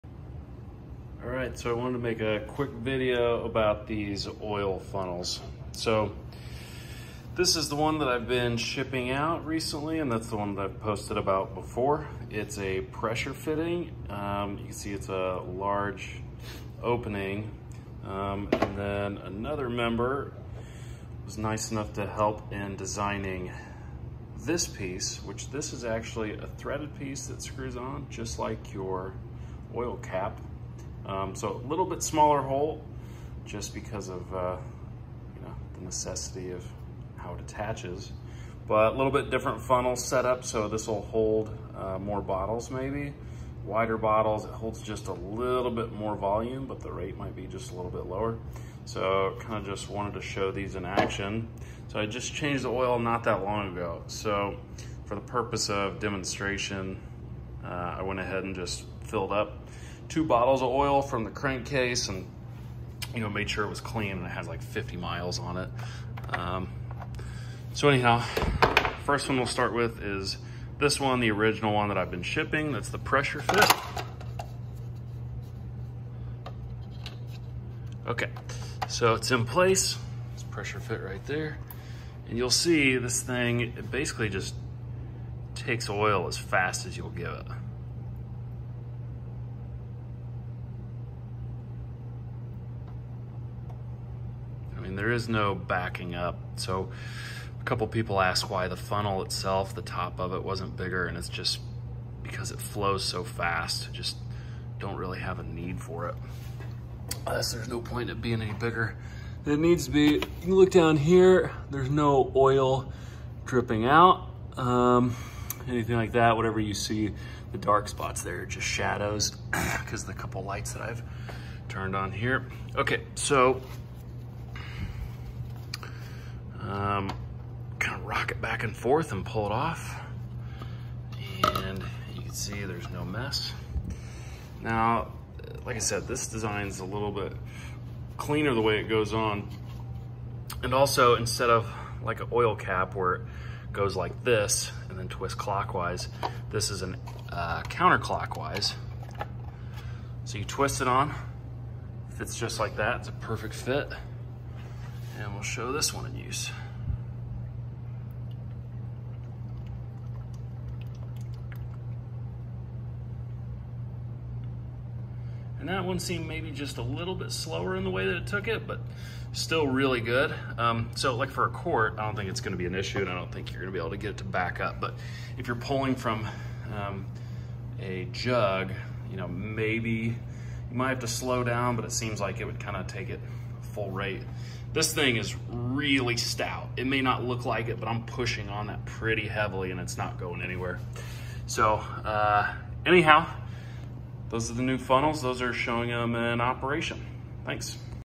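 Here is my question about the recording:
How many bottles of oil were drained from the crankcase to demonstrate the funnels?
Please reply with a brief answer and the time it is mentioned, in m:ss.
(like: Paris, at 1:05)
2, at 1:00.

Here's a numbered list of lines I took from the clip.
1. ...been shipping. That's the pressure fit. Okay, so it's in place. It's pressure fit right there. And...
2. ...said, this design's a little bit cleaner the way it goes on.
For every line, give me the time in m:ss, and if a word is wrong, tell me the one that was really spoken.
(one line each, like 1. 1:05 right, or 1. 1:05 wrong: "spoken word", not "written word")
1. 1:12 right
2. 2:15 right.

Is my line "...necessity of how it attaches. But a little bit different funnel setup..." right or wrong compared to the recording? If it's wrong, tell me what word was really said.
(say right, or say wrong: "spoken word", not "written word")
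right.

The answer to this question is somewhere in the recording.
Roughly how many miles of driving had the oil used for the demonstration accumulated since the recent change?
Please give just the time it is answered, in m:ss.
1:04.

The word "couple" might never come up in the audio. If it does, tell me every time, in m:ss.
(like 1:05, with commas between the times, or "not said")
1:37, 2:00.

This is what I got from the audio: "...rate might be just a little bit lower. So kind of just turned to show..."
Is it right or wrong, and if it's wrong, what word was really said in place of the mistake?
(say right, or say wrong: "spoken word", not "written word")
wrong: "wanted", not "turned".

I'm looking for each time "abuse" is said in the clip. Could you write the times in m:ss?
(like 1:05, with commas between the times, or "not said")
not said.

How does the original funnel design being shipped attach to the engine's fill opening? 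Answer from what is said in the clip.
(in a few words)
Pressure fitting.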